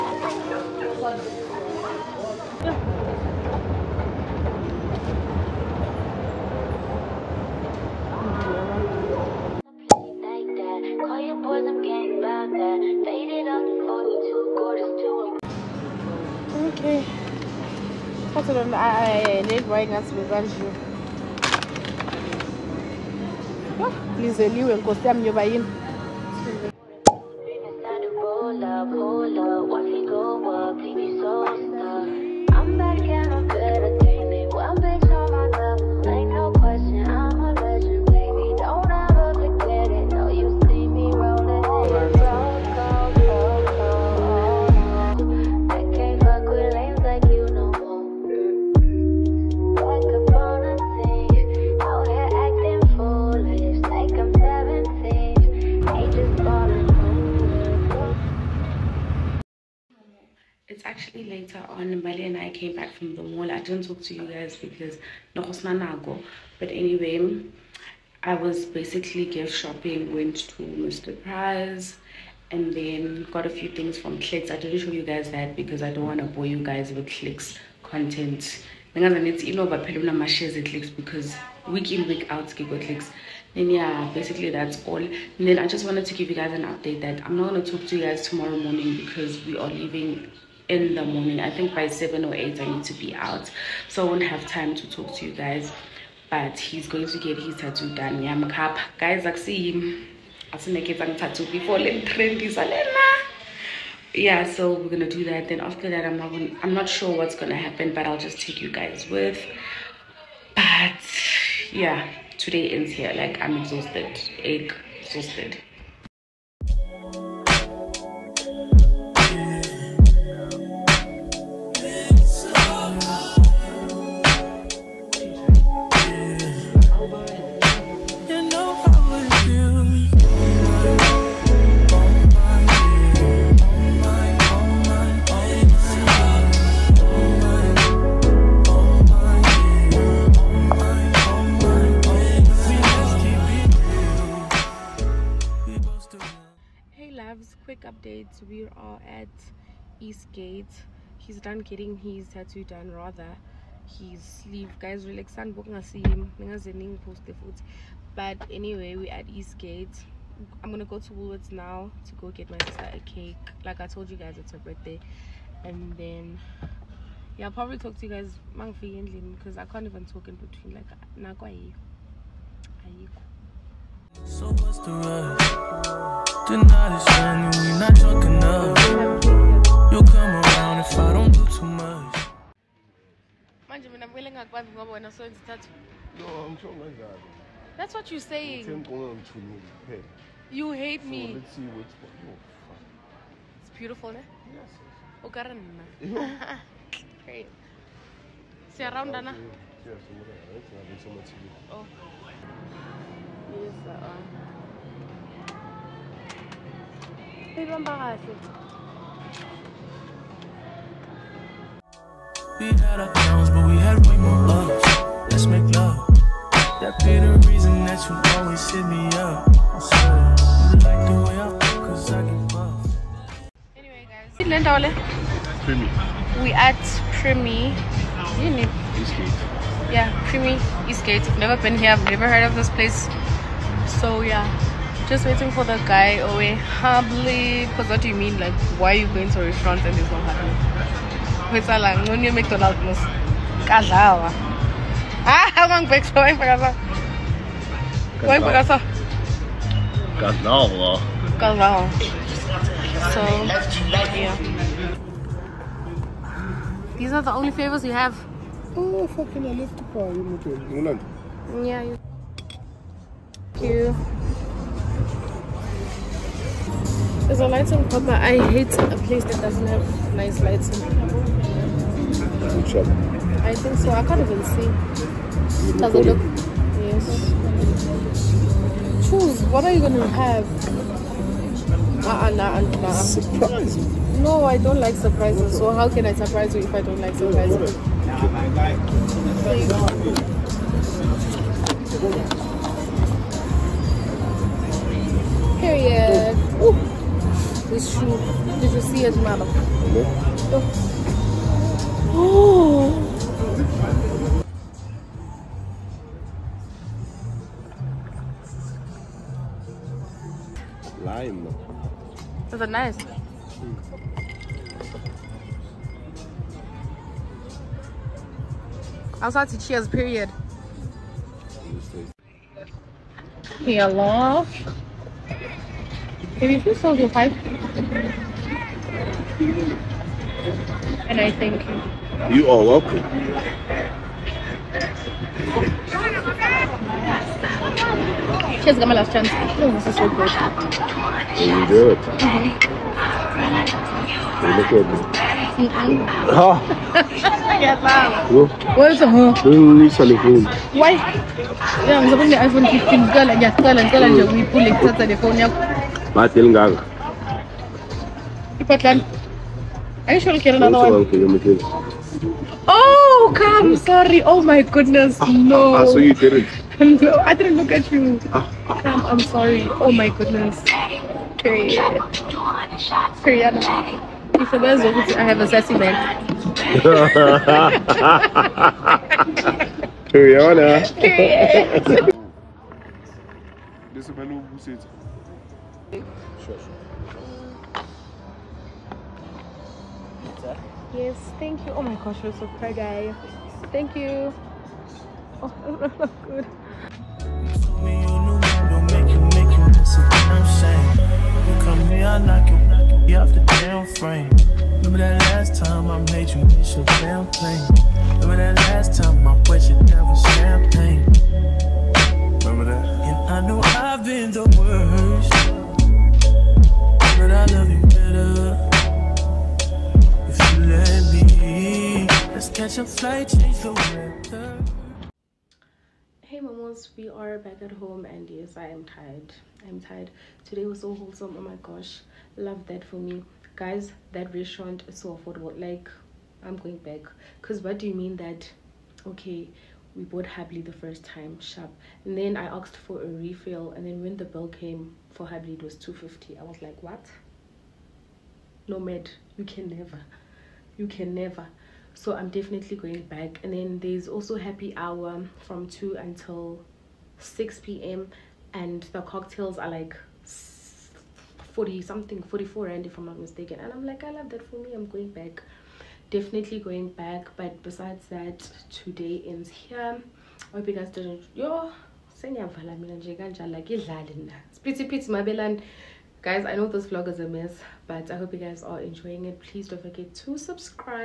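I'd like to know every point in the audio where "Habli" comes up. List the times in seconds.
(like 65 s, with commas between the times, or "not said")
440 s, 445 s.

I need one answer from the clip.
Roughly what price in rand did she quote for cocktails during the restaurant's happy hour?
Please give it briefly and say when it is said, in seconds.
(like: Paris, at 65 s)
44, at 462 s.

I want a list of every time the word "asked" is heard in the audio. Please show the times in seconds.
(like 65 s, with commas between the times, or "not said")
442 s.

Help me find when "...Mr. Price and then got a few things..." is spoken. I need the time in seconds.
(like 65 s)
70 s.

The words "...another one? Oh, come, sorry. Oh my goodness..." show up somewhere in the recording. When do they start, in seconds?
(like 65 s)
360 s.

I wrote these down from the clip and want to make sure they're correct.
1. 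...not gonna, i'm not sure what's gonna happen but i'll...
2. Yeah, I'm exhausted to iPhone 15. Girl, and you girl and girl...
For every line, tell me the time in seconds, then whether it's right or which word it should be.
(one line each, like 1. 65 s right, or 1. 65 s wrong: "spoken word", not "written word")
1. 106 s right
2. 351 s wrong: "supposed", not "exhausted".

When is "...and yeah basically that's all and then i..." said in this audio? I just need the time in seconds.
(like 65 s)
83 s.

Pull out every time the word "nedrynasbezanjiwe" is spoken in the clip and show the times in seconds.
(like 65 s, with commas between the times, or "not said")
19 s.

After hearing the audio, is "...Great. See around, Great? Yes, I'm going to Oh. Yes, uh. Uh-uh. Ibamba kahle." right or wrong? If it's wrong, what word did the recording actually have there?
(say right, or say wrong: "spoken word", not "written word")
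wrong: "Dana", not "Great".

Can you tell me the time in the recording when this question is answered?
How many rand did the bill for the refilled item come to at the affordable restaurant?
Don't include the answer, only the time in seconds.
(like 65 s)
445 s.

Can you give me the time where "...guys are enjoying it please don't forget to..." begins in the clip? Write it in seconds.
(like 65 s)
478 s.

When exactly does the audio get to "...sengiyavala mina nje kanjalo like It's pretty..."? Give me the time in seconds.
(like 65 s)
472 s.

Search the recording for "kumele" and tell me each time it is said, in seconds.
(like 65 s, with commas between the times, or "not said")
184 s.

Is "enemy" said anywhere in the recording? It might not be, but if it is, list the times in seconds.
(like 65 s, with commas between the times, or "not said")
not said.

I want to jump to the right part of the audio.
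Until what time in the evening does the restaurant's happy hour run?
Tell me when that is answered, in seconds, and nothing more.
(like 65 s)
457 s.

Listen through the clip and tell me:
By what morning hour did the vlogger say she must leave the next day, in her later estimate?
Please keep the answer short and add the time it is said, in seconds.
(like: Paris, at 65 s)
8, at 92 s.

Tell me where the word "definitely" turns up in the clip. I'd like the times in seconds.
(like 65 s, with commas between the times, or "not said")
452 s, 466 s.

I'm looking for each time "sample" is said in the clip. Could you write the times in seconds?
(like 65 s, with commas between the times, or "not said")
not said.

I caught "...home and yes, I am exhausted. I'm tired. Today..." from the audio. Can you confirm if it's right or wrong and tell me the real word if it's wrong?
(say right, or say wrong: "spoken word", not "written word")
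wrong: "tired", not "exhausted".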